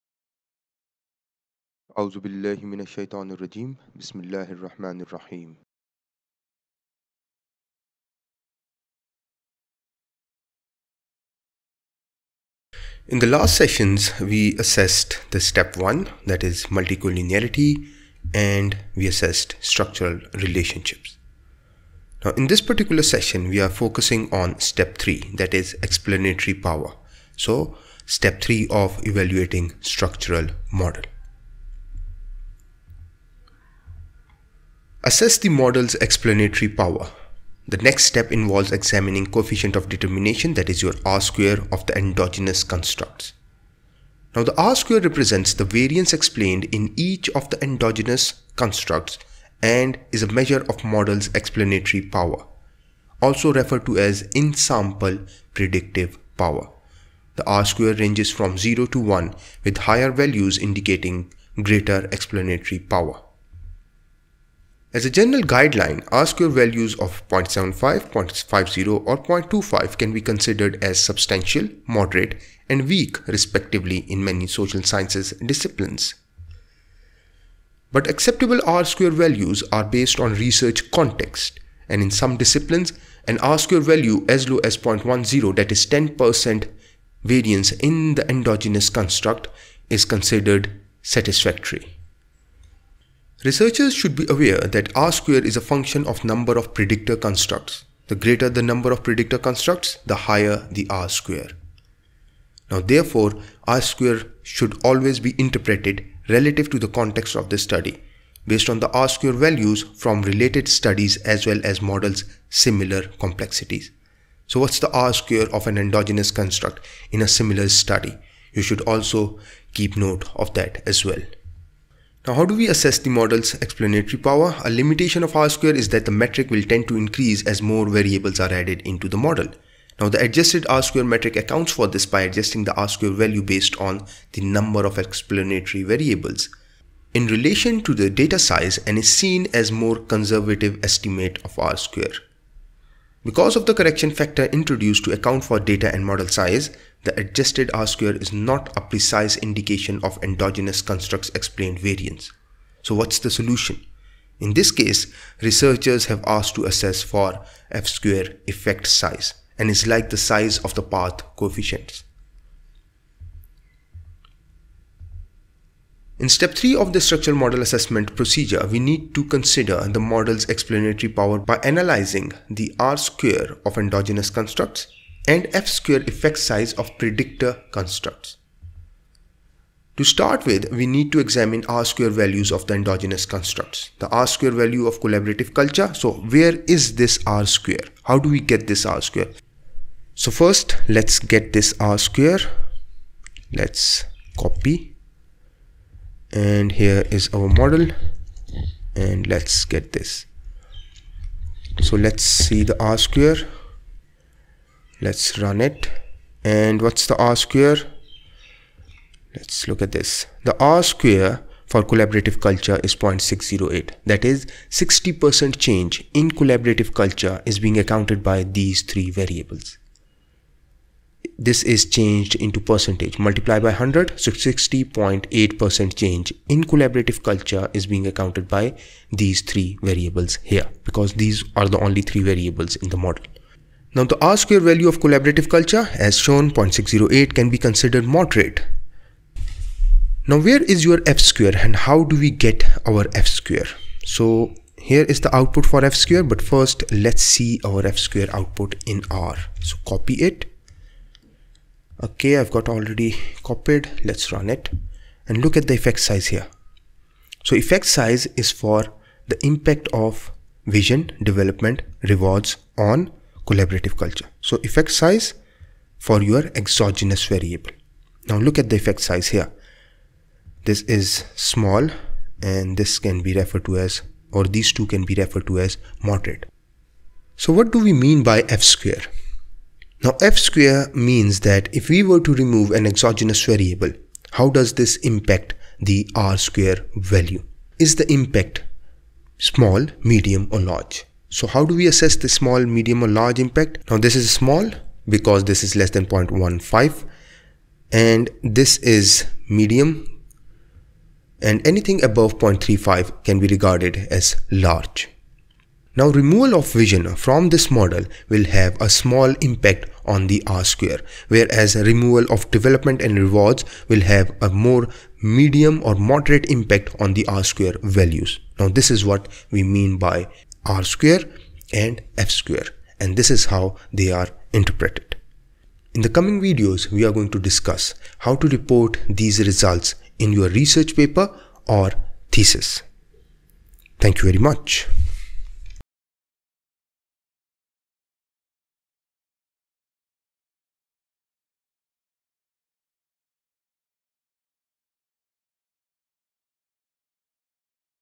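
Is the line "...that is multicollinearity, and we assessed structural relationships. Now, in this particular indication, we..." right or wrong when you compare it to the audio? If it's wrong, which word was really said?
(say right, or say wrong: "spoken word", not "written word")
wrong: "session", not "indication".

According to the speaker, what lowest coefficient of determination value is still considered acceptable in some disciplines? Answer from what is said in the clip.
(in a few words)
0.10.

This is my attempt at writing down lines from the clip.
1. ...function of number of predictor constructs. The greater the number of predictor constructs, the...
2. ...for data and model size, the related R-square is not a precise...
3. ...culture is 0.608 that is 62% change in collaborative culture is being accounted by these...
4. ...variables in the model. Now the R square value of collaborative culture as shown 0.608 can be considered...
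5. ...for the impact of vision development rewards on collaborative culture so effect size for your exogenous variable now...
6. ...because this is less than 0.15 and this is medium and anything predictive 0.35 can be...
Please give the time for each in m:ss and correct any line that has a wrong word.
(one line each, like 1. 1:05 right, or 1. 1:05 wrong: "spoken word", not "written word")
1. 1:35 right
2. 2:25 wrong: "adjusted", not "related"
3. 3:32 wrong: "60", not "62"
4. 3:52 right
5. 4:18 right
6. 4:55 wrong: "above", not "predictive".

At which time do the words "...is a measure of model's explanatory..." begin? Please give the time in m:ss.
0:50.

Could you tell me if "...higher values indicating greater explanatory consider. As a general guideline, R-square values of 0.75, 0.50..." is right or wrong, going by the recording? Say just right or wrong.
wrong.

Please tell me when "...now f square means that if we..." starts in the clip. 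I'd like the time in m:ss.
4:40.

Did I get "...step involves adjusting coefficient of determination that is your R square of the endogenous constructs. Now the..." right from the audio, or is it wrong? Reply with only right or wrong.
wrong.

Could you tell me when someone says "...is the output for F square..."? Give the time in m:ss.
4:05.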